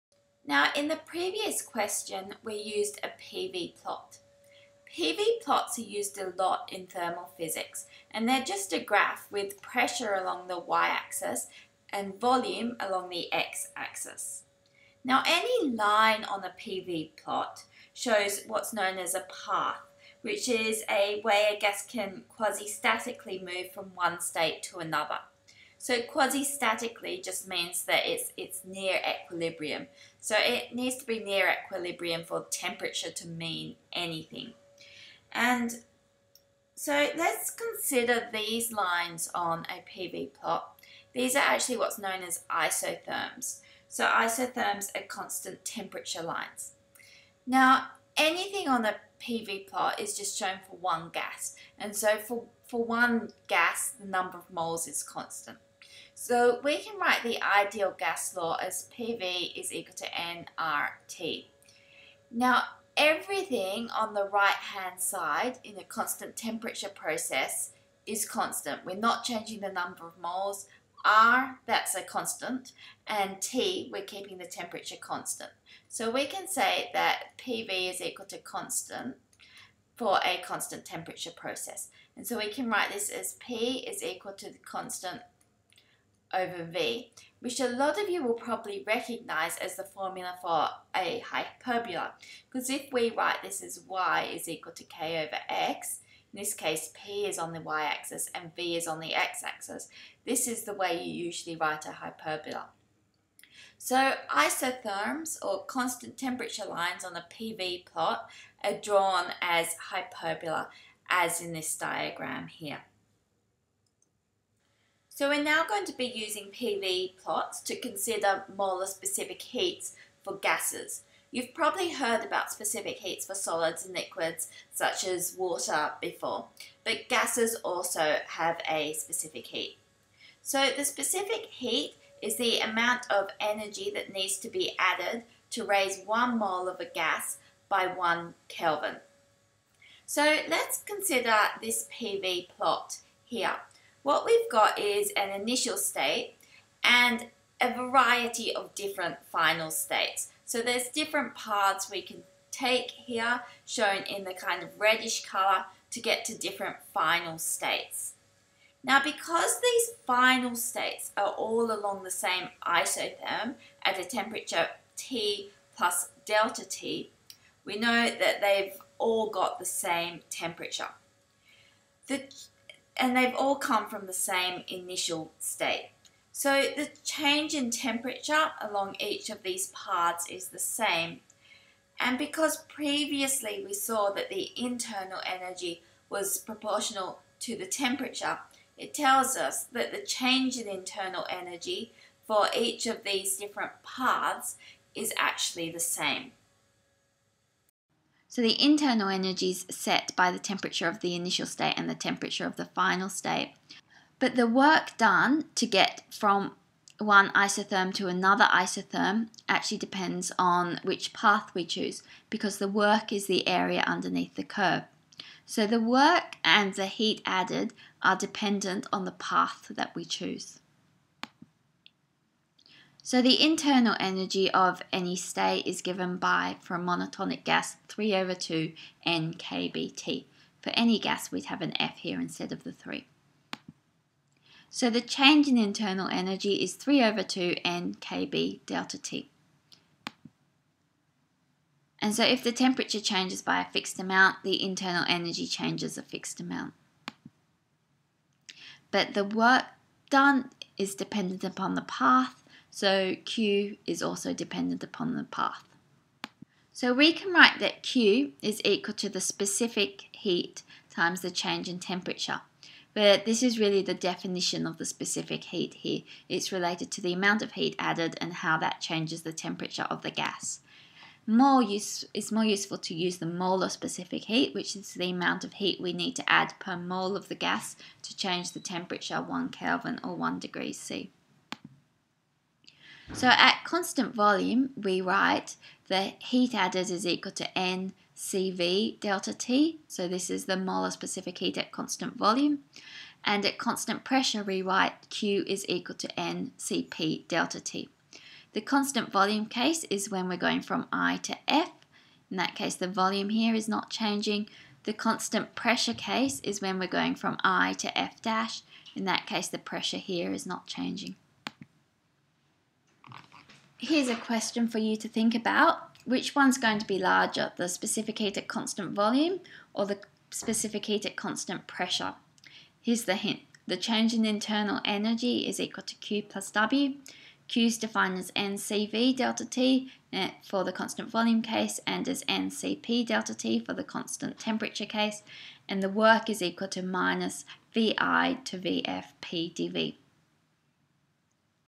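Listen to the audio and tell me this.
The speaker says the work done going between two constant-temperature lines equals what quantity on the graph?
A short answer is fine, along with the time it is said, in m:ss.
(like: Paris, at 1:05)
area underneath the curve, at 3:33.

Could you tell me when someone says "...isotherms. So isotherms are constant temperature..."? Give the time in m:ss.
0:42.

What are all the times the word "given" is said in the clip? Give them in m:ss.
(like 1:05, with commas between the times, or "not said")
3:45.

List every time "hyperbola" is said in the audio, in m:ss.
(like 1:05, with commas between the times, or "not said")
1:31, 1:41, 1:49.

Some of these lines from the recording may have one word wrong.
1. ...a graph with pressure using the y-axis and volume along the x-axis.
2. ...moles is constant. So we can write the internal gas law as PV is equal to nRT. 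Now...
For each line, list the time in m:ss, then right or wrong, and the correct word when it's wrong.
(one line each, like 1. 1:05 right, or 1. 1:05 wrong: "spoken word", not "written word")
1. 0:08 wrong: "along", not "using"
2. 0:54 wrong: "ideal", not "internal".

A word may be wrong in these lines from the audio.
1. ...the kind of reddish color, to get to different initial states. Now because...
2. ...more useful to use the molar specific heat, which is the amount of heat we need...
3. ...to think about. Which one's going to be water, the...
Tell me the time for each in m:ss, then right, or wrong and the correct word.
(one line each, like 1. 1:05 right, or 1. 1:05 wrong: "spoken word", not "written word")
1. 2:34 wrong: "final", not "initial"
2. 4:32 right
3. 5:14 wrong: "larger", not "water".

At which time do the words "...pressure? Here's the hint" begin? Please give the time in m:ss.
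5:21.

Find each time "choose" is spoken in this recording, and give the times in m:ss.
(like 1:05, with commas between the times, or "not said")
3:31, 3:40.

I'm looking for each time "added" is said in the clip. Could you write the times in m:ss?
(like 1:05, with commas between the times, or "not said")
2:14, 3:37, 4:27, 4:46.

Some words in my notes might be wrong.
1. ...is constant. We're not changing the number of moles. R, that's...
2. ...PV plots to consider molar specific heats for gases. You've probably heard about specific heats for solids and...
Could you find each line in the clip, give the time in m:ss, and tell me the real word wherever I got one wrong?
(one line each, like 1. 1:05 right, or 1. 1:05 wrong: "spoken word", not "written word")
1. 1:08 right
2. 1:56 right.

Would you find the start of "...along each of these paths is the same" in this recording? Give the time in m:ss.
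2:58.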